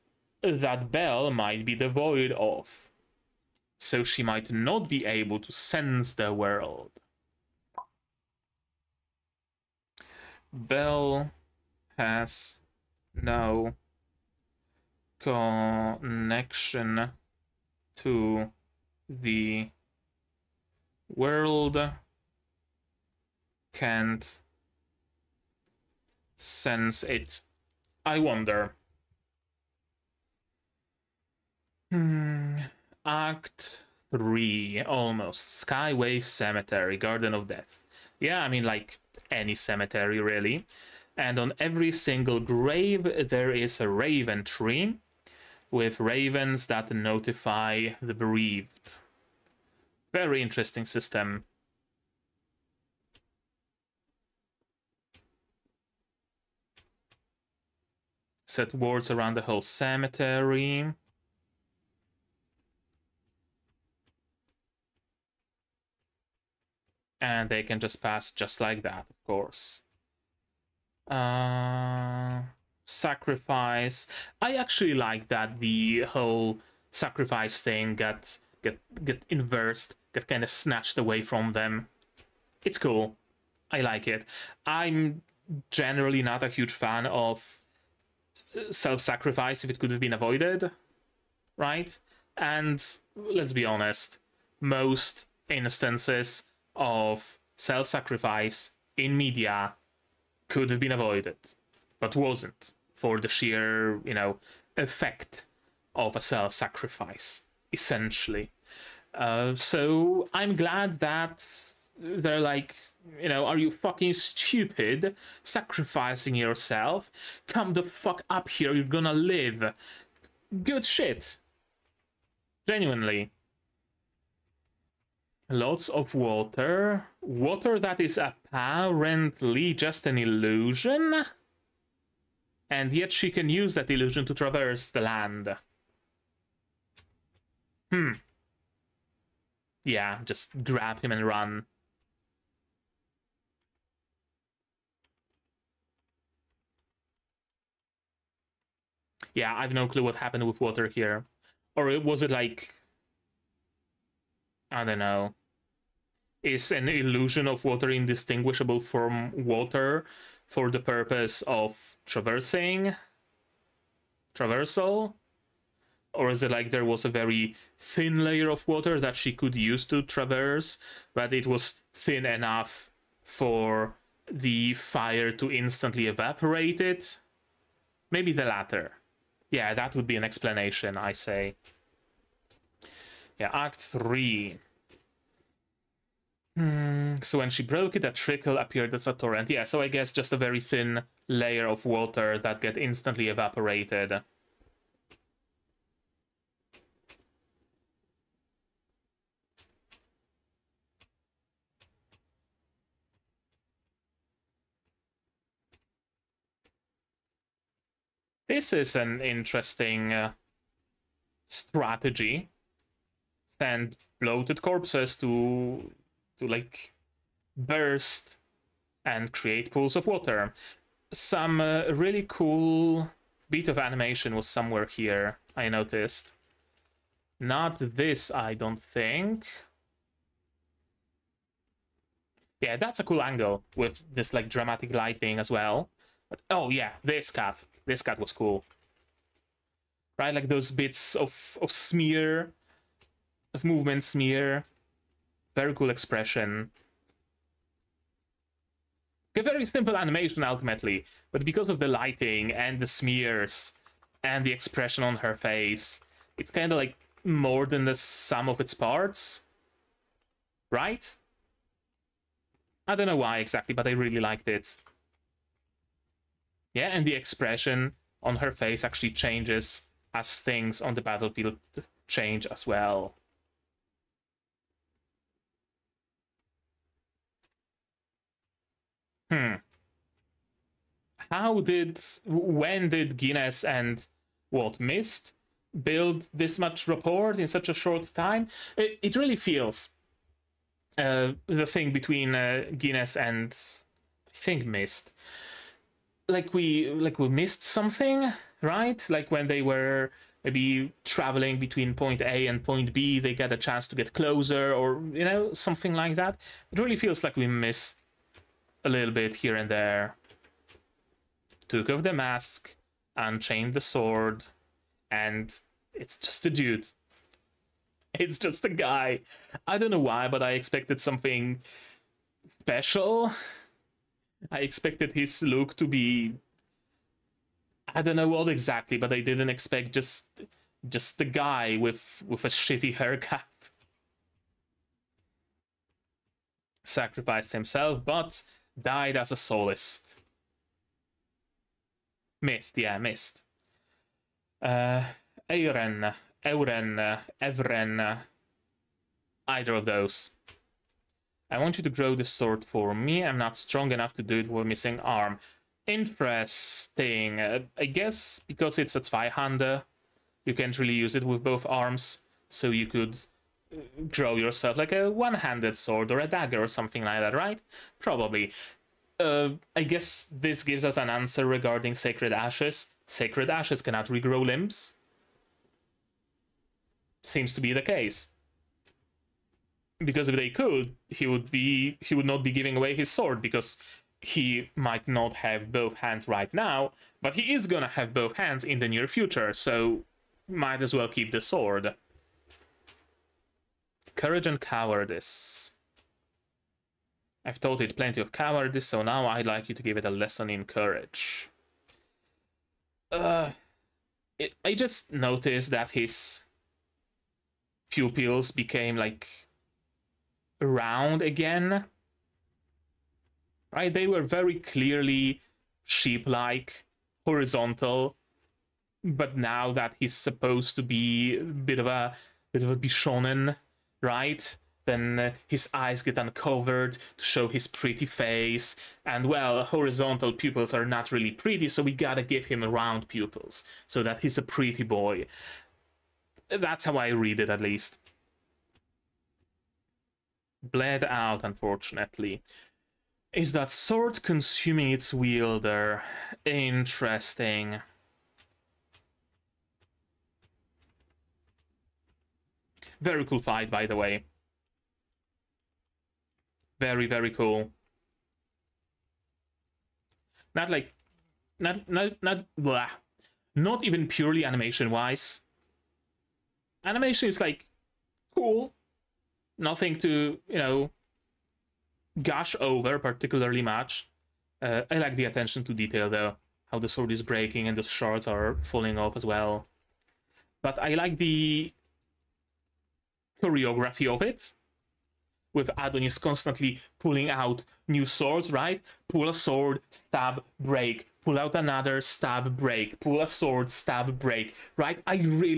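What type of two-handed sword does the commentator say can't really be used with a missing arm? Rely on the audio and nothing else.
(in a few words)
Zweihander.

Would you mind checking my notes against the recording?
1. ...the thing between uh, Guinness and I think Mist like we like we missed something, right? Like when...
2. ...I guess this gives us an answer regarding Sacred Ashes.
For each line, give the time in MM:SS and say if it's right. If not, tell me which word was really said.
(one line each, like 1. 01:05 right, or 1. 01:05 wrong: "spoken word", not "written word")
1. 04:51 right
2. 06:09 right.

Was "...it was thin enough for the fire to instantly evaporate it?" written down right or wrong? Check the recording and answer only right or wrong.
right.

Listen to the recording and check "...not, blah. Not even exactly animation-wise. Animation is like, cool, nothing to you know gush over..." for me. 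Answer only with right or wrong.
wrong.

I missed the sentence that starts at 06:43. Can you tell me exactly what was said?
Uh, it, I just noticed that his pupils became like around again.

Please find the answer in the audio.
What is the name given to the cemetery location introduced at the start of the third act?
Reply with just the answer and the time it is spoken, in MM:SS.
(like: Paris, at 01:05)
Skyway Cemetery, at 00:35.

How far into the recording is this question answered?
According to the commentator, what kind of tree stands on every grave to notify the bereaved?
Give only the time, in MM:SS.
00:43.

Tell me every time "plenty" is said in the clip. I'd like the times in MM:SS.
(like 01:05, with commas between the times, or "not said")
06:37.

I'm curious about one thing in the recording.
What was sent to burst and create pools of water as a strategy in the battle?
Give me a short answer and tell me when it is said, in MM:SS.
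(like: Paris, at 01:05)
Bloated corpses, at 03:34.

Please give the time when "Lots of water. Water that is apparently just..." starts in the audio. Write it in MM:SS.
02:05.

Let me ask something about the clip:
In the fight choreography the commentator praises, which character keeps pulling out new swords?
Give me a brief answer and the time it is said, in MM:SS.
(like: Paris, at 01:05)
Adonis, at 08:05.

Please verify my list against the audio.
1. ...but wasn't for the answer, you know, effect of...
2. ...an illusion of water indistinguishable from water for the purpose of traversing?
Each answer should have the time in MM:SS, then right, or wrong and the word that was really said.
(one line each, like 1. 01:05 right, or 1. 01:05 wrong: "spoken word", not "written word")
1. 01:41 wrong: "sheer", not "answer"
2. 02:36 right.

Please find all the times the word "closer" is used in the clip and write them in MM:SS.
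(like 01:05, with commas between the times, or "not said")
05:04.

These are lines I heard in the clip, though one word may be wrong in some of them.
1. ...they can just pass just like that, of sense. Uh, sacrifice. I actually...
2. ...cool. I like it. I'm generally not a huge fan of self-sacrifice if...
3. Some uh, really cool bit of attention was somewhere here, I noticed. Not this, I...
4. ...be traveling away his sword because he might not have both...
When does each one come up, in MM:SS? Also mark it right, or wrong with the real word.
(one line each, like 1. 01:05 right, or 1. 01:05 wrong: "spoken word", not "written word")
1. 01:07 wrong: "course", not "sense"
2. 01:22 right
3. 03:41 wrong: "animation", not "attention"
4. 06:22 wrong: "giving", not "traveling".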